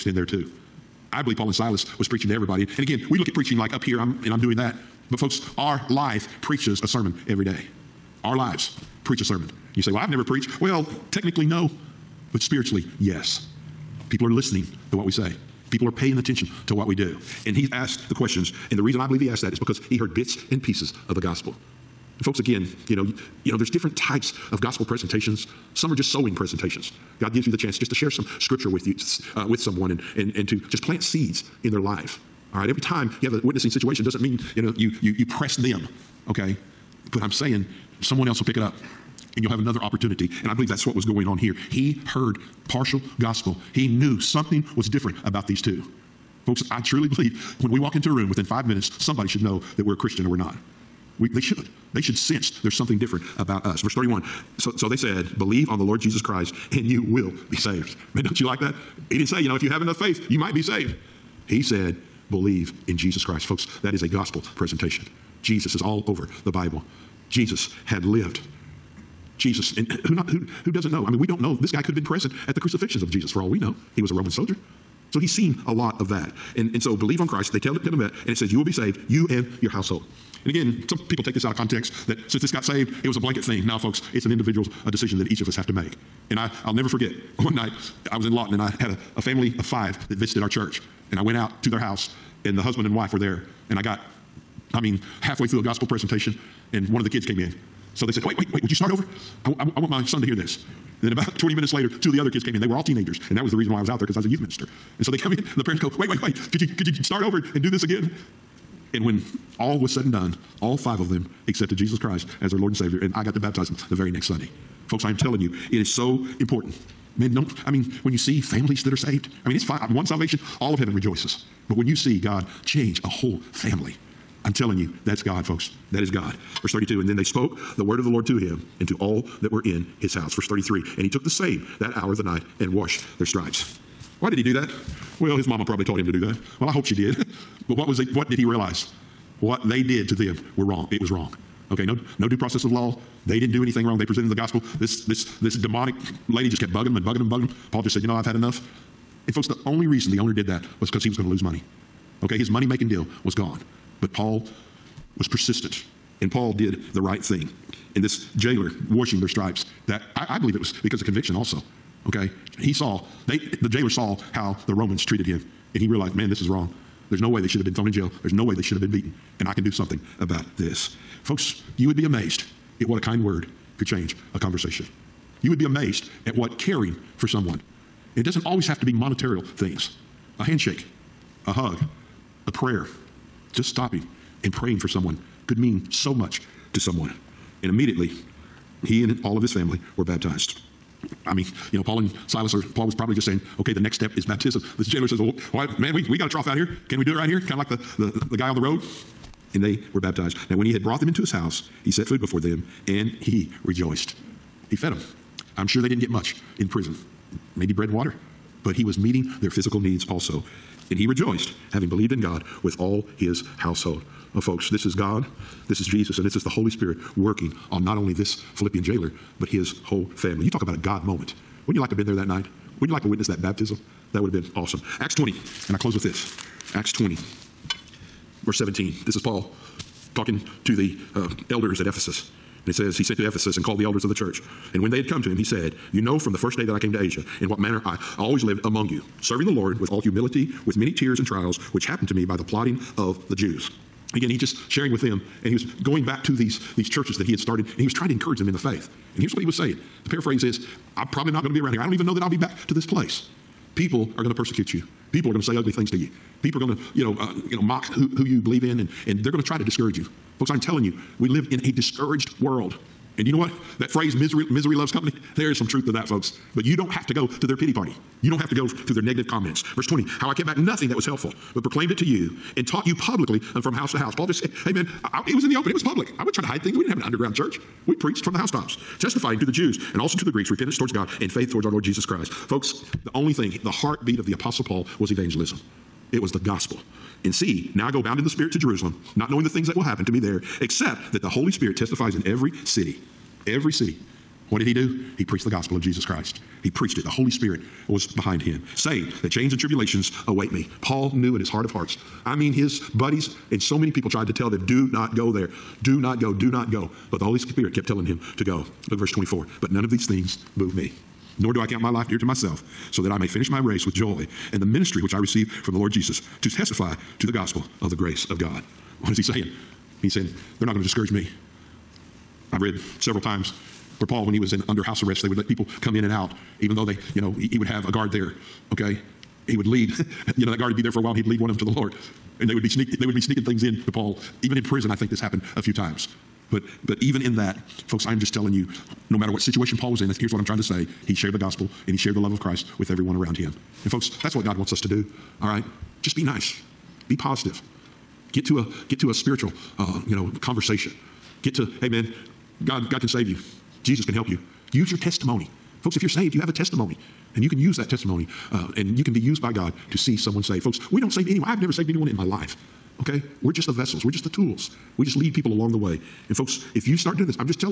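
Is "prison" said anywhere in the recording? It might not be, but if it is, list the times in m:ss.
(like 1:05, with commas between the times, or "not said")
3:26, 5:34.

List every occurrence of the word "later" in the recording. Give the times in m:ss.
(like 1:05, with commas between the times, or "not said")
1:41.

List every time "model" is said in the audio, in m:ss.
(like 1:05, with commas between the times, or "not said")
not said.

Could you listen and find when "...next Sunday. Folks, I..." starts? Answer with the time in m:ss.
1:54.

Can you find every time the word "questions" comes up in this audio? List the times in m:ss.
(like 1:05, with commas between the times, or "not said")
0:18.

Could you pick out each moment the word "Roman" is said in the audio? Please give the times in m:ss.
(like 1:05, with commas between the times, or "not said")
1:14, 2:44.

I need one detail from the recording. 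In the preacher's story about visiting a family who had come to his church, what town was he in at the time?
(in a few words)
Lawton.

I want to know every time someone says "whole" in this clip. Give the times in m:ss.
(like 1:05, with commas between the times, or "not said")
2:03, 3:39.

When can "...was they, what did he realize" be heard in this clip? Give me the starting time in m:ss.
2:17.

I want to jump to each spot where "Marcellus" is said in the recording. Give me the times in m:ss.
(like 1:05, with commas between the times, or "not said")
not said.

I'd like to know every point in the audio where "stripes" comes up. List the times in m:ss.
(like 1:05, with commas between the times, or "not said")
2:13, 2:39.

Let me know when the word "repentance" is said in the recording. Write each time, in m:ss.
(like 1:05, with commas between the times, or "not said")
4:40.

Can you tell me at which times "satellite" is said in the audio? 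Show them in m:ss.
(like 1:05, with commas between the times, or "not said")
not said.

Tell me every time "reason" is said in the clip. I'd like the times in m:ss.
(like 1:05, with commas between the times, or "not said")
0:18, 1:43, 2:29.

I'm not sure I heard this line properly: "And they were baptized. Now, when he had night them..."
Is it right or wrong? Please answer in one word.
wrong.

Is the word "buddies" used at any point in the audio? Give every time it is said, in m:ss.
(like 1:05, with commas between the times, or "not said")
5:02.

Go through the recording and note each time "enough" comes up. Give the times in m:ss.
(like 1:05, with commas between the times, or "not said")
0:59, 2:28.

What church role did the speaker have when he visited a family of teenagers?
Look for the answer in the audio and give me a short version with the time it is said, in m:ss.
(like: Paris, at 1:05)
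youth minister, at 1:44.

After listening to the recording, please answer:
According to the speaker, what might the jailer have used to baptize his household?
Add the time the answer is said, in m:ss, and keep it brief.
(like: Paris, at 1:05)
a trough, at 3:16.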